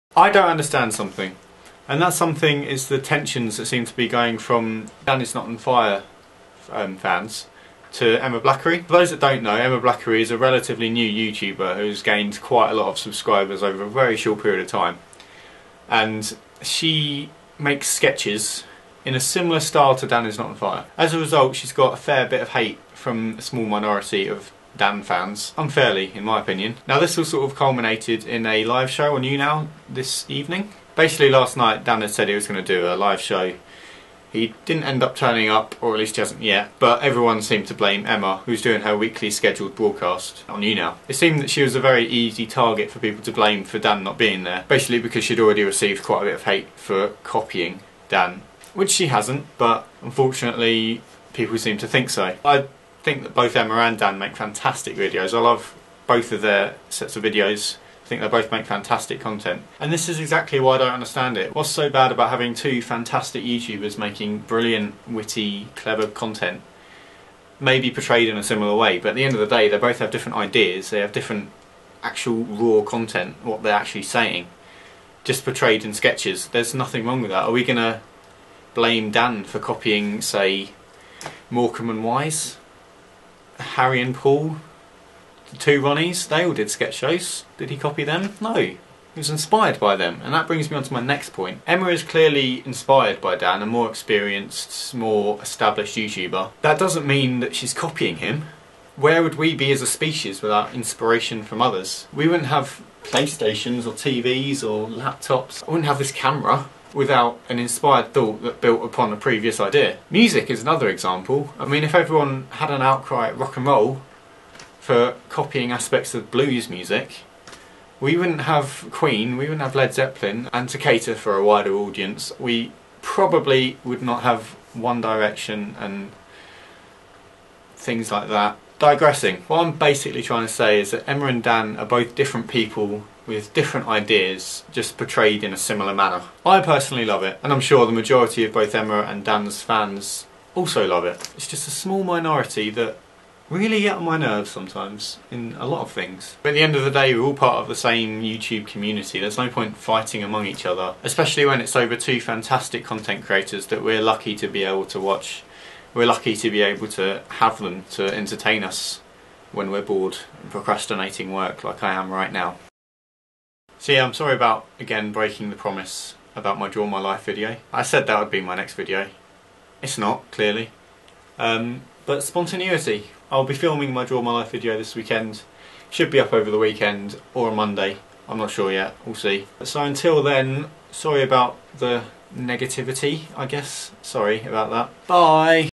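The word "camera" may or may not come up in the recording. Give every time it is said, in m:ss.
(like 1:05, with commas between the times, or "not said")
1:46.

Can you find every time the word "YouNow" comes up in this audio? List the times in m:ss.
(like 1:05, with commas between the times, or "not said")
0:29, 0:40.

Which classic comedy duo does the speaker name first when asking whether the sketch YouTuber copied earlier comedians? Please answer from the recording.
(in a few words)
Morecambe and Wise.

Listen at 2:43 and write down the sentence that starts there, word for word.
So yeah, I'm sorry about, again, breaking the promise about my Draw My Life video.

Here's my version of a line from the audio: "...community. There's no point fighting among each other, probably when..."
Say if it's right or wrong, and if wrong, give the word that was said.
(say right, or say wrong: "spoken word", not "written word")
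wrong: "especially", not "probably".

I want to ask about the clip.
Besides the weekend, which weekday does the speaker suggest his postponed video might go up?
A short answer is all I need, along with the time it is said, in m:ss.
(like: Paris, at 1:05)
Monday, at 2:57.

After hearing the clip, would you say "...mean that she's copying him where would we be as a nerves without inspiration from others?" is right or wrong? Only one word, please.
wrong.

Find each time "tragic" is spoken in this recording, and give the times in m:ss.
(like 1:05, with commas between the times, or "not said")
not said.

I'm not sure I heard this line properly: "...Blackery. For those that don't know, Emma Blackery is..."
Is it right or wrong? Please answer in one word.
right.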